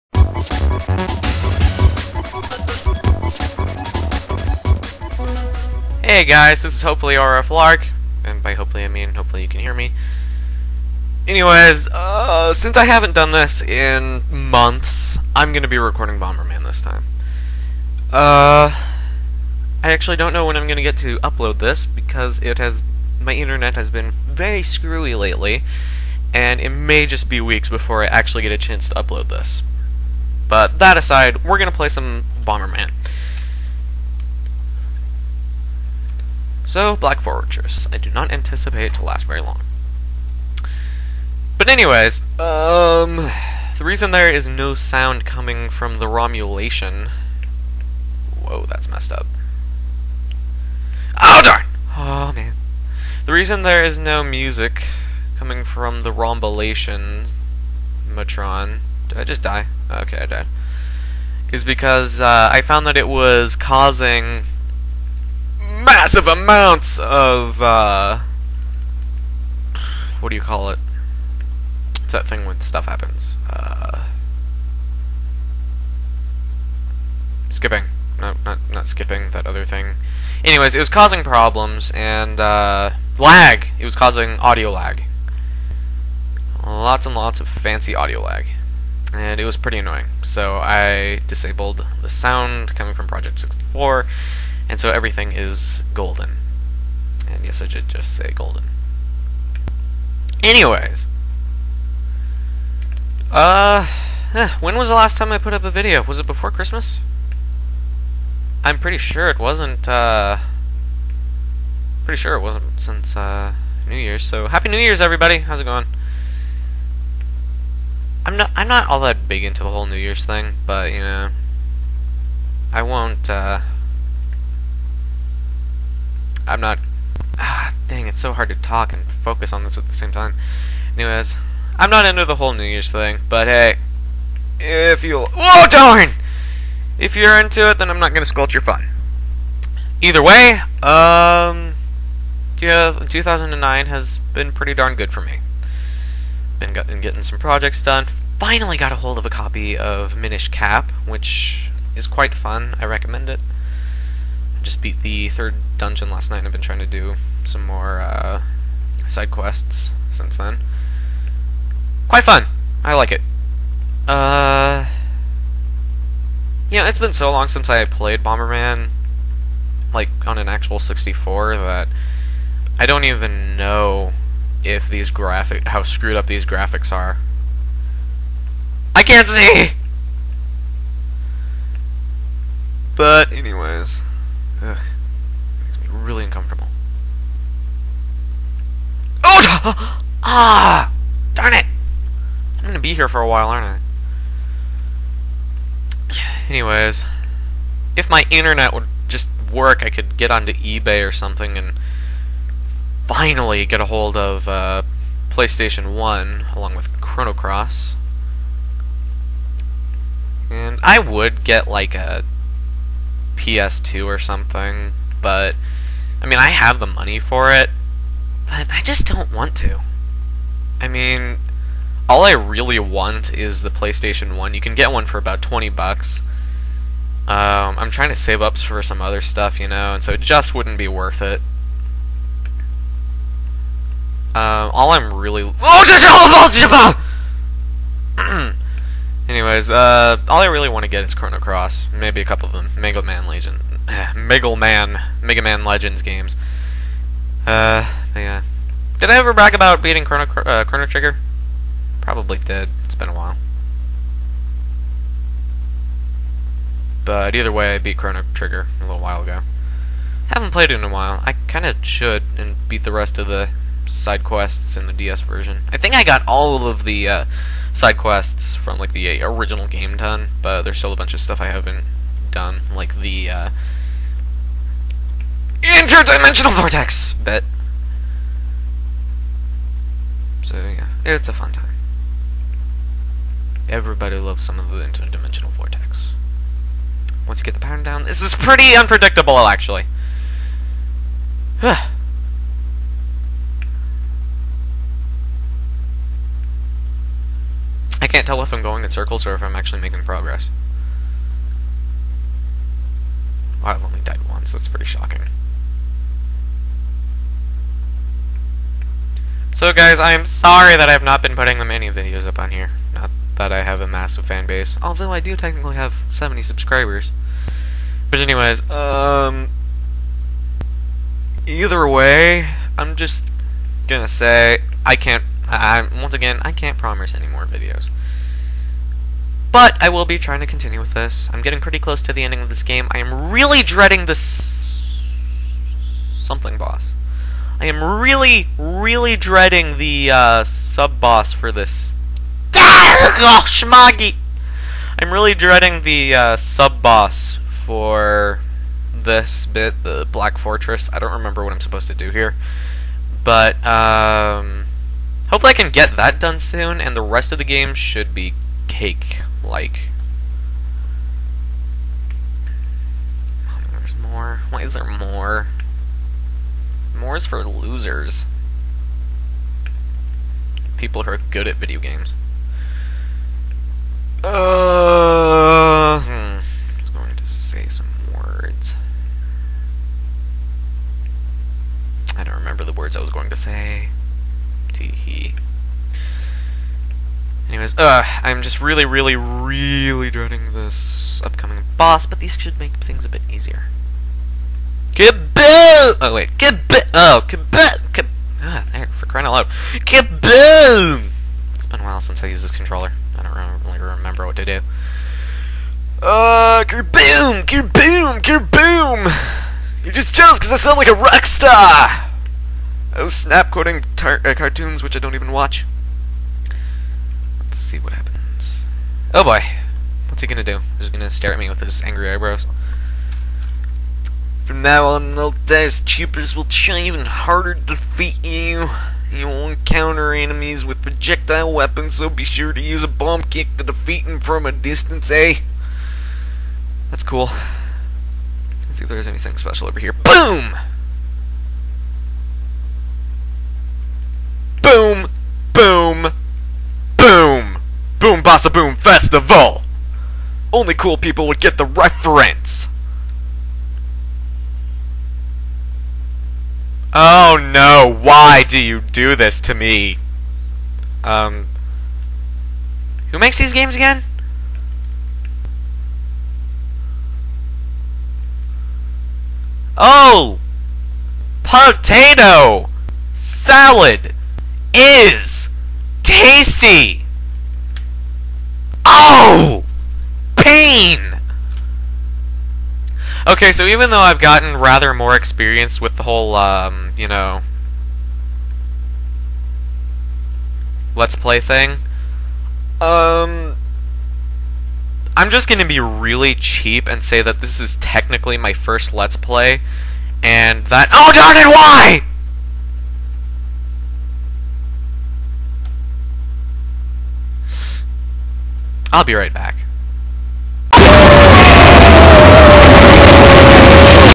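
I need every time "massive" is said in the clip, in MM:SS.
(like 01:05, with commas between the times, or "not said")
01:05, 05:13.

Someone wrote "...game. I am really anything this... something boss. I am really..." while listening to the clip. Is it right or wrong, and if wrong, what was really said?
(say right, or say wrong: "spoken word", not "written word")
wrong: "dreading", not "anything".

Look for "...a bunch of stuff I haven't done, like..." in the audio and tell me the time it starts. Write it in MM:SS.
04:30.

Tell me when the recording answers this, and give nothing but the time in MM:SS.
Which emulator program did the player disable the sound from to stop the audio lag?
01:33.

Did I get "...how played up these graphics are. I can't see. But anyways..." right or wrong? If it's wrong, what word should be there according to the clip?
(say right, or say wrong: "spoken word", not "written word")
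wrong: "screwed", not "played".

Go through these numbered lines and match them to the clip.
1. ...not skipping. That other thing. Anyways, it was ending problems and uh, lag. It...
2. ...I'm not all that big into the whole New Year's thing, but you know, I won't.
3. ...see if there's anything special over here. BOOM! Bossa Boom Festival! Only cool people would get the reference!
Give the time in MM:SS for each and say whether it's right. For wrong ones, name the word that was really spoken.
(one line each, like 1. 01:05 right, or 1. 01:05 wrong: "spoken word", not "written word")
1. 01:18 wrong: "causing", not "ending"
2. 01:58 right
3. 07:18 right.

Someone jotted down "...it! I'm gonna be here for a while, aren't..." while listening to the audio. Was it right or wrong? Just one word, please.
right.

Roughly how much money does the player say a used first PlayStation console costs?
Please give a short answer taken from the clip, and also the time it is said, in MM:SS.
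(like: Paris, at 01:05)
20 bucks, at 03:45.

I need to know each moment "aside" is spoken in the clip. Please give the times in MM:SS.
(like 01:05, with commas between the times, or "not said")
00:30.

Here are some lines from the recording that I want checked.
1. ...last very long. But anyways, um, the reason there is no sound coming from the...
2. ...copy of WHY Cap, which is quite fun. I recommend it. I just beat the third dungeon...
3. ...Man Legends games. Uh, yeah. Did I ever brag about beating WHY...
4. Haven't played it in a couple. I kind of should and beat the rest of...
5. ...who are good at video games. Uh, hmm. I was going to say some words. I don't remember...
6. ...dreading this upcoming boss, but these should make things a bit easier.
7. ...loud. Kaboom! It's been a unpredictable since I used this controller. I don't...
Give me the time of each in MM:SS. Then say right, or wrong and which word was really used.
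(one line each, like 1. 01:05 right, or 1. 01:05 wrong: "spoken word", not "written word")
1. 00:39 right
2. 02:29 wrong: "Minish", not "WHY"
3. 04:05 wrong: "Chrono", not "WHY"
4. 04:20 wrong: "while", not "couple"
5. 06:11 right
6. 06:30 right
7. 06:39 wrong: "while", not "unpredictable".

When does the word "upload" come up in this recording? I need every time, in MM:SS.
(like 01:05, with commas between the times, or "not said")
00:21, 00:28.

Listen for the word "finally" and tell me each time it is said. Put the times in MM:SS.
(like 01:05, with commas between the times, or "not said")
02:28, 03:23.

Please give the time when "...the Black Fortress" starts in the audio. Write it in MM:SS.
05:49.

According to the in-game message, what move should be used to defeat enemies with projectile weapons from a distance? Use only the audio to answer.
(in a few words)
bomb kick.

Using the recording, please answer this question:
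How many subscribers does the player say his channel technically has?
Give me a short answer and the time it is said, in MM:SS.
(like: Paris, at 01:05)
70, at 05:16.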